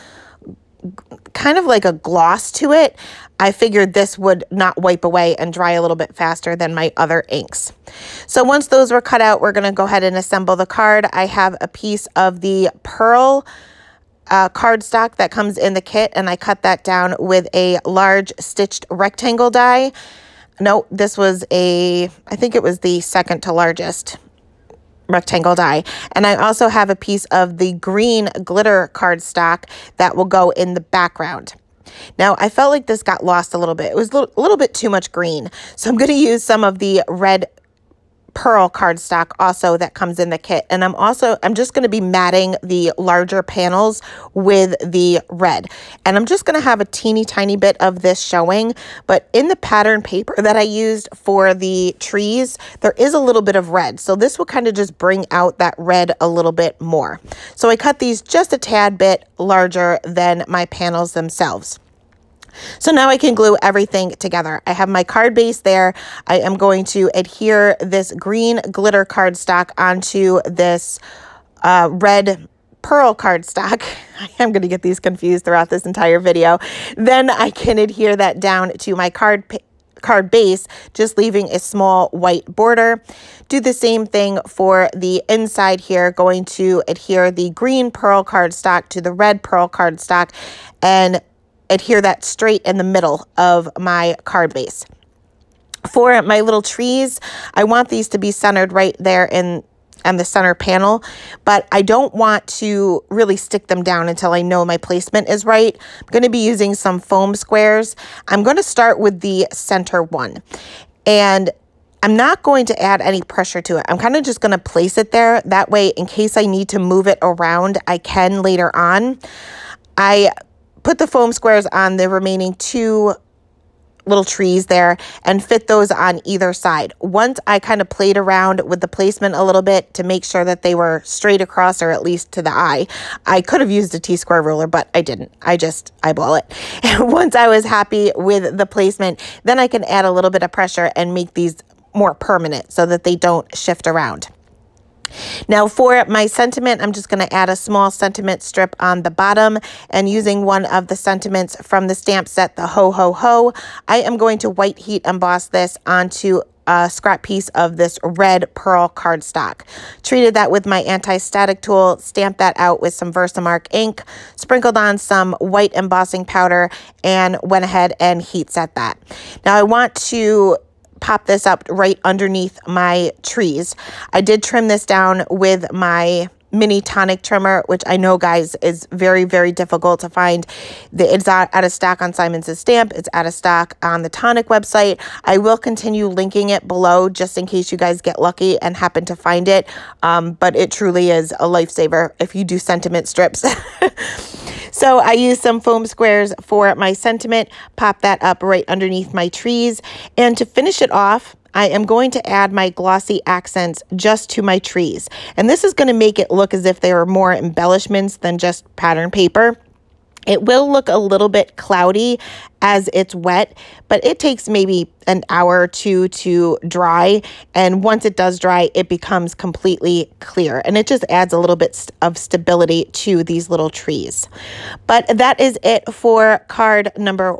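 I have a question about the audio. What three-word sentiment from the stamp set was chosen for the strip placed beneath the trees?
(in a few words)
Ho Ho Ho.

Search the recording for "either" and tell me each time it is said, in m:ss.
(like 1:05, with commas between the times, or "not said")
2:06.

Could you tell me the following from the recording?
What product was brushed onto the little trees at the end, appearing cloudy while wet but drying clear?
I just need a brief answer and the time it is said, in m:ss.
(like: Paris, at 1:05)
Glossy Accents, at 3:22.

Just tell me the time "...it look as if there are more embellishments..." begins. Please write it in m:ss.
3:26.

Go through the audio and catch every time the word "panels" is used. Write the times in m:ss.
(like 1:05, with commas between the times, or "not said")
0:43, 1:00, 1:40.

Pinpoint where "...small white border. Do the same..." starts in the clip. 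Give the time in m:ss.
1:21.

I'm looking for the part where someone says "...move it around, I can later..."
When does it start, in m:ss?
1:56.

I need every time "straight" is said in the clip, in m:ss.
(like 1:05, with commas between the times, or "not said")
1:32, 2:11.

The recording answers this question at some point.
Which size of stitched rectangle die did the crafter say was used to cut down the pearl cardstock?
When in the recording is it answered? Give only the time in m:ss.
0:23.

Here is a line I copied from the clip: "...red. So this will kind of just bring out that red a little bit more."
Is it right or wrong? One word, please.
right.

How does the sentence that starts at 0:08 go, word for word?
So once those were cut out, we're going to go ahead and assemble the card.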